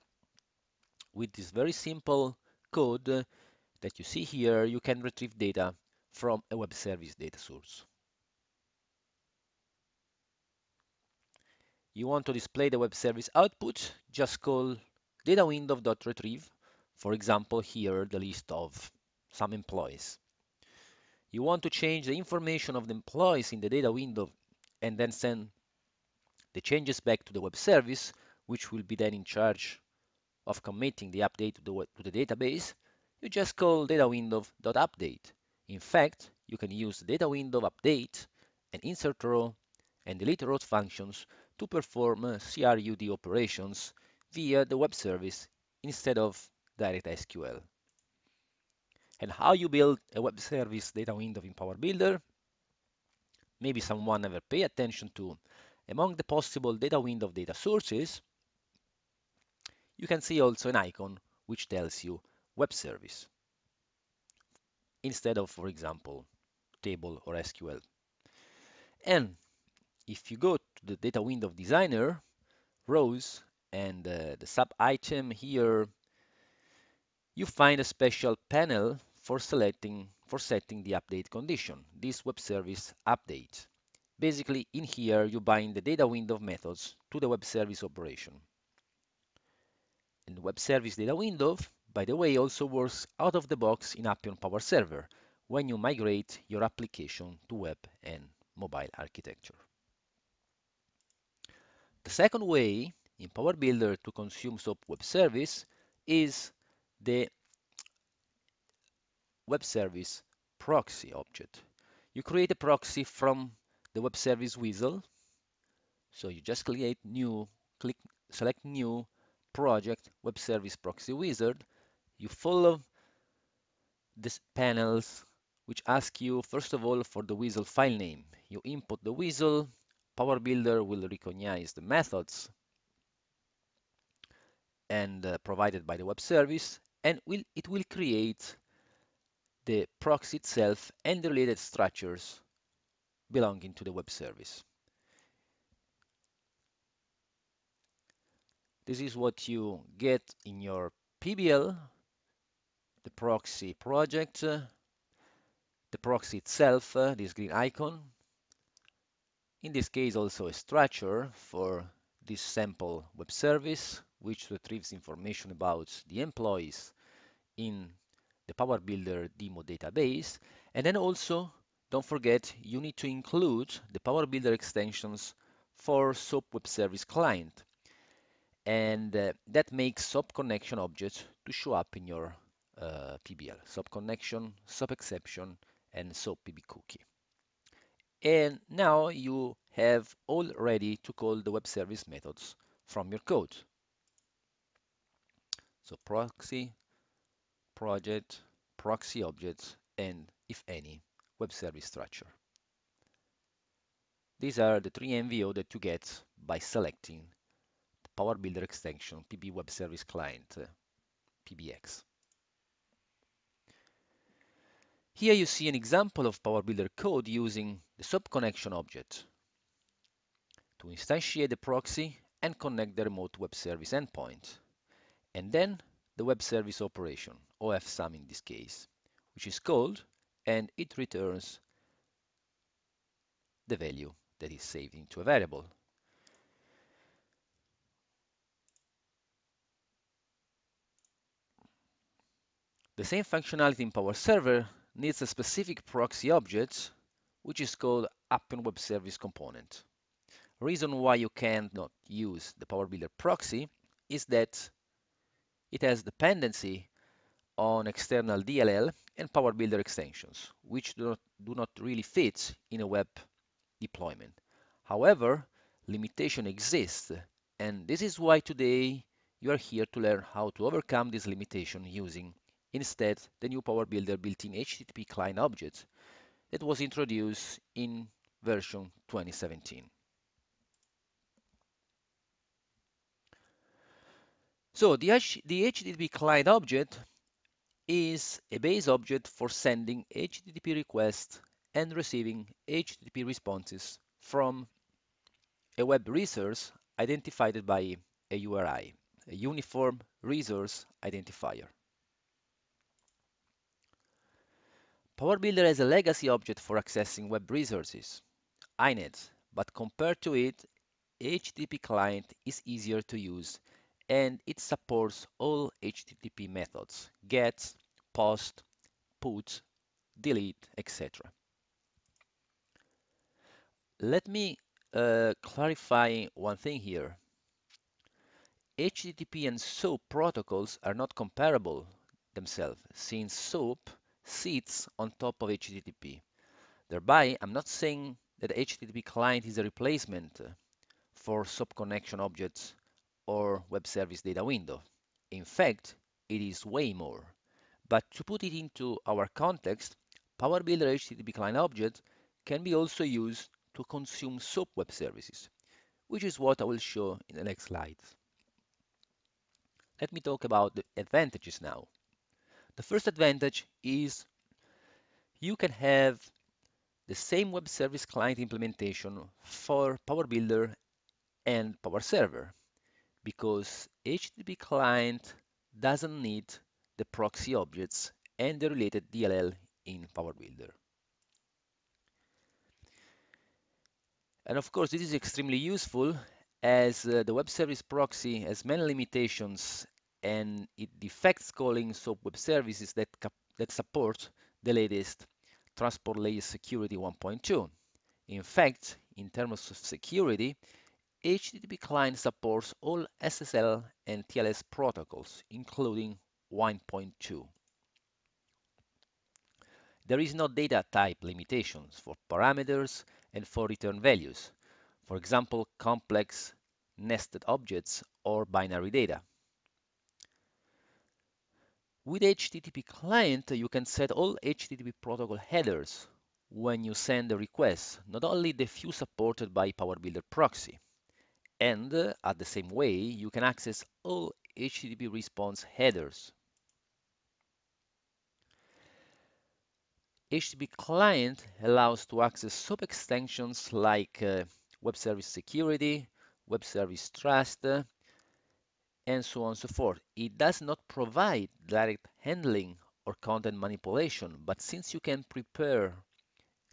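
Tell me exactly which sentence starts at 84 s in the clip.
Basically, in here, you bind the data window methods to the web service operation.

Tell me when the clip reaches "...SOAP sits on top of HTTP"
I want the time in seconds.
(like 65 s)
333 s.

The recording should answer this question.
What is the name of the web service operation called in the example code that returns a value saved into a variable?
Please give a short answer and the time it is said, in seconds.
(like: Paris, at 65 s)
OFSum, at 227 s.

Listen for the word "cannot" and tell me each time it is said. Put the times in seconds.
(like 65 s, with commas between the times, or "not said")
251 s.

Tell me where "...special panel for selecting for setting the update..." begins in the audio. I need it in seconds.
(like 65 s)
77 s.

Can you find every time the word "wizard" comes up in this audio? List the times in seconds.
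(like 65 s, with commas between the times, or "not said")
114 s, 121 s.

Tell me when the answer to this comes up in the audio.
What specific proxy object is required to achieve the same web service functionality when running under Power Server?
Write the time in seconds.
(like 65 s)
248 s.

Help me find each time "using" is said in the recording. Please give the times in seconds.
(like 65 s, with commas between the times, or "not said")
217 s, 271 s.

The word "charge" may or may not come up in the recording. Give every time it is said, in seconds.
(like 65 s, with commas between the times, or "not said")
29 s.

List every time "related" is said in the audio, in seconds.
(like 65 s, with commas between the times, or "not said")
141 s, 378 s.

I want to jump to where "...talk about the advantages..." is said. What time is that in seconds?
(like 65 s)
360 s.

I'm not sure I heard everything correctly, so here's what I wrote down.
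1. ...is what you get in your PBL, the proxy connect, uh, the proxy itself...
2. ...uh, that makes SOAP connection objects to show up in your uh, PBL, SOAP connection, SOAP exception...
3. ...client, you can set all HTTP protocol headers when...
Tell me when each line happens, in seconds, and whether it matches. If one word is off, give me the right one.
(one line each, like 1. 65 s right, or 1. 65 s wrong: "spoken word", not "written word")
1. 149 s wrong: "project", not "connect"
2. 179 s right
3. 422 s right.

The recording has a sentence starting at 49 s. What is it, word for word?
And how you build a web service data window in Power Builder?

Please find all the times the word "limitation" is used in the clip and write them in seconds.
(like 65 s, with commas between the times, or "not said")
265 s, 271 s, 388 s, 411 s.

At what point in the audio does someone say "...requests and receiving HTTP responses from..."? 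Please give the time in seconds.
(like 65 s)
290 s.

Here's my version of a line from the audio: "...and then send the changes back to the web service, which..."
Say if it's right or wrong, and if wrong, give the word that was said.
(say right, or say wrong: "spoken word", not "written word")
right.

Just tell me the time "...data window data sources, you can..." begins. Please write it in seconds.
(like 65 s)
56 s.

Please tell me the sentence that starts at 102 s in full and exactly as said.
The second way in Power Builder to consume SOAP web service is the web service proxy object.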